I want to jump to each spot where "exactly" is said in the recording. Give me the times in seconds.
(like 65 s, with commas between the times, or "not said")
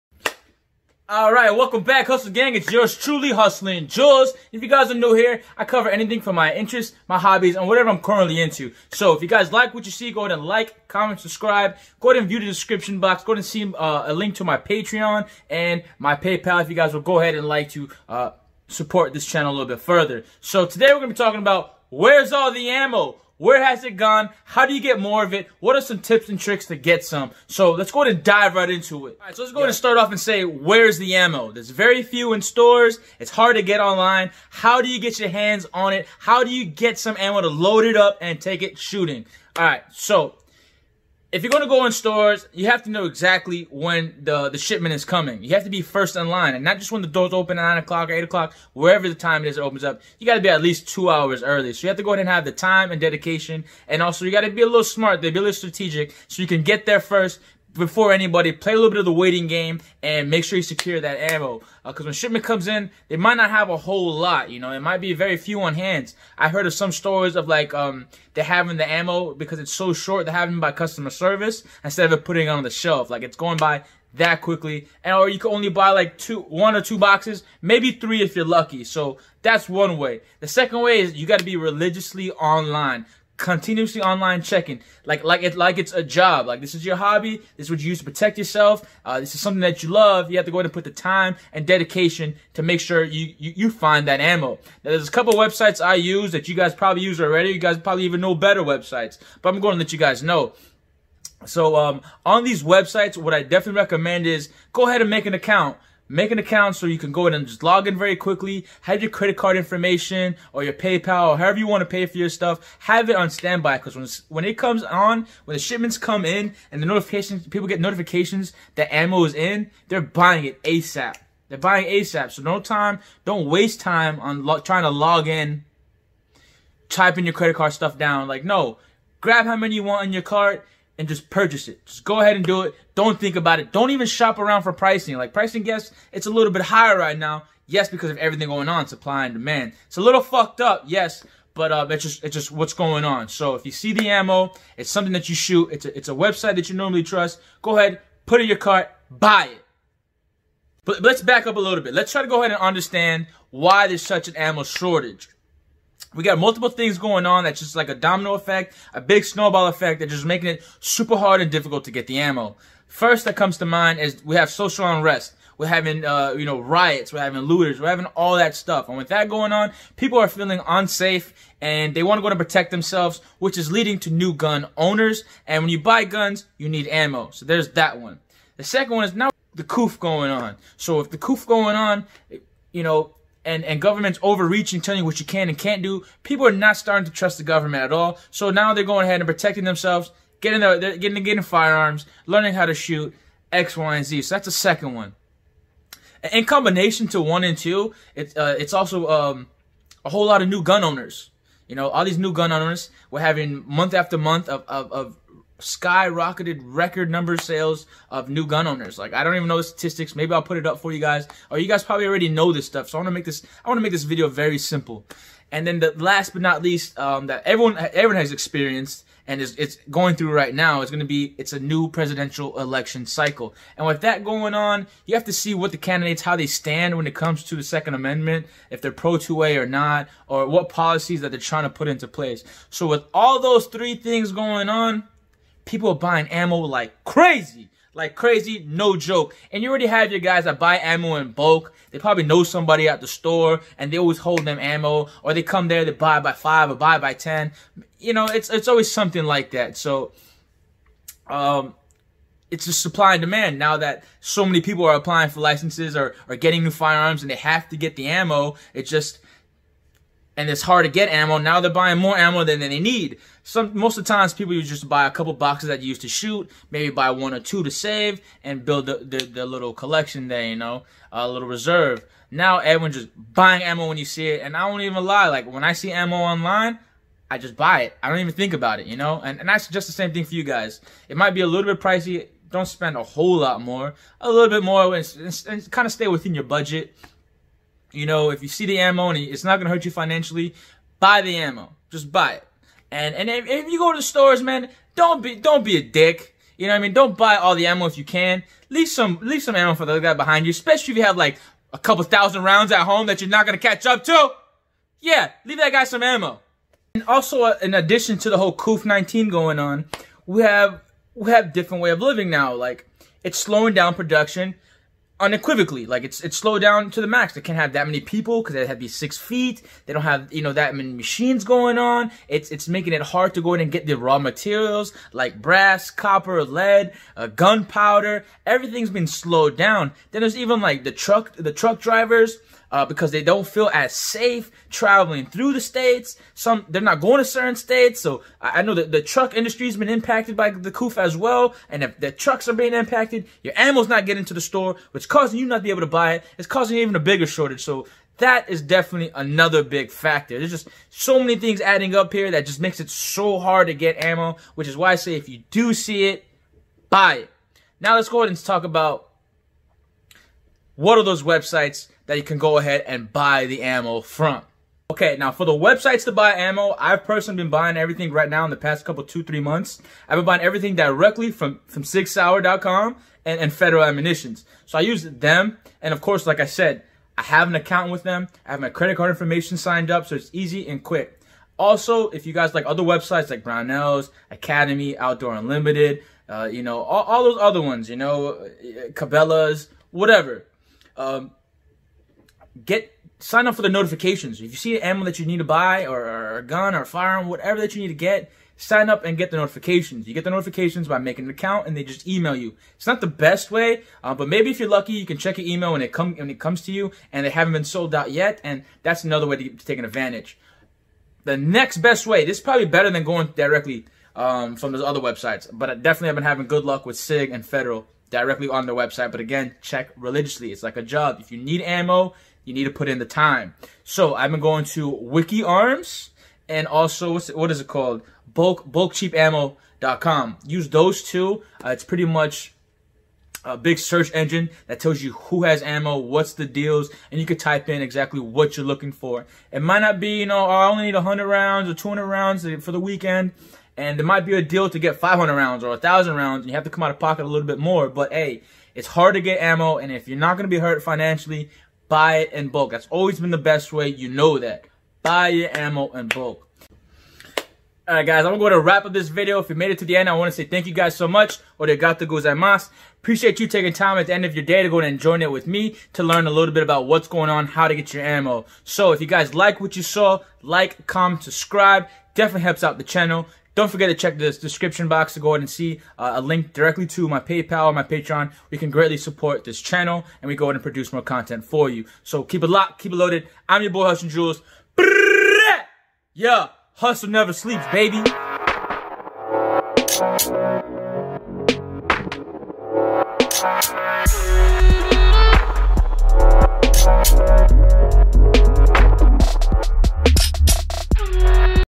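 43 s, 437 s.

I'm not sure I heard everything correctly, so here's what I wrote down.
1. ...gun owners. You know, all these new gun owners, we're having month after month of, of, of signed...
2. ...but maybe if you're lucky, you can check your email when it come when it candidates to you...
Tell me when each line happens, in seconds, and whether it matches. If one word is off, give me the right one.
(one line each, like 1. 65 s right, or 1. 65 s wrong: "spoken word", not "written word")
1. 200 s wrong: "skyrocketed", not "signed"
2. 404 s wrong: "comes", not "candidates".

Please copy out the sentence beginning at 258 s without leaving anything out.
It just, and it's hard to get ammo.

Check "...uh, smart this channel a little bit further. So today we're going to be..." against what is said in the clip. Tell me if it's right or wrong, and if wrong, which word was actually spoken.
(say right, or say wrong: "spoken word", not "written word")
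wrong: "support", not "smart".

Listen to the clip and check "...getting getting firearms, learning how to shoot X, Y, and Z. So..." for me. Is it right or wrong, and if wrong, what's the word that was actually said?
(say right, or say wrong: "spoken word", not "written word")
right.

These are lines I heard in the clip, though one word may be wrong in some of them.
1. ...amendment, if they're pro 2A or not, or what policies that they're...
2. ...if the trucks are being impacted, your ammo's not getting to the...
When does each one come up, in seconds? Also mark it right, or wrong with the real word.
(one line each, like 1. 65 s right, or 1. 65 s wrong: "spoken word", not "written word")
1. 227 s right
2. 341 s right.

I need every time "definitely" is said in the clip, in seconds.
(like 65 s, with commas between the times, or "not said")
103 s, 348 s, 415 s, 472 s.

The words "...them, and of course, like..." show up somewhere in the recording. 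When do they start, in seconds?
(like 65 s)
375 s.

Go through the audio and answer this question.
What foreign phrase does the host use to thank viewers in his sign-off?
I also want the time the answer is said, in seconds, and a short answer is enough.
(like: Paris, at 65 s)
Odegato gozaimasu, at 461 s.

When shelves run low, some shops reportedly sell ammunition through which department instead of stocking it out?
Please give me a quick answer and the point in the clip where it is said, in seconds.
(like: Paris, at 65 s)
customer service, at 70 s.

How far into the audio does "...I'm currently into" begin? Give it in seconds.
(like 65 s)
7 s.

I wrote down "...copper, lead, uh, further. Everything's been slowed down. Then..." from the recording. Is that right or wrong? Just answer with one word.
wrong.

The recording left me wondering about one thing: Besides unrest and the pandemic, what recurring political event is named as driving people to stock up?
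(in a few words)
presidential election cycle.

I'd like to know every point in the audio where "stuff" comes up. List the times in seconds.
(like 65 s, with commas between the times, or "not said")
112 s, 127 s, 168 s, 212 s.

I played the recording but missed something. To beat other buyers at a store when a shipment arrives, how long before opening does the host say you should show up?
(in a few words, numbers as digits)
2 hours.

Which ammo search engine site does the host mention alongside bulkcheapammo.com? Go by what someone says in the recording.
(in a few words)
WikiArms.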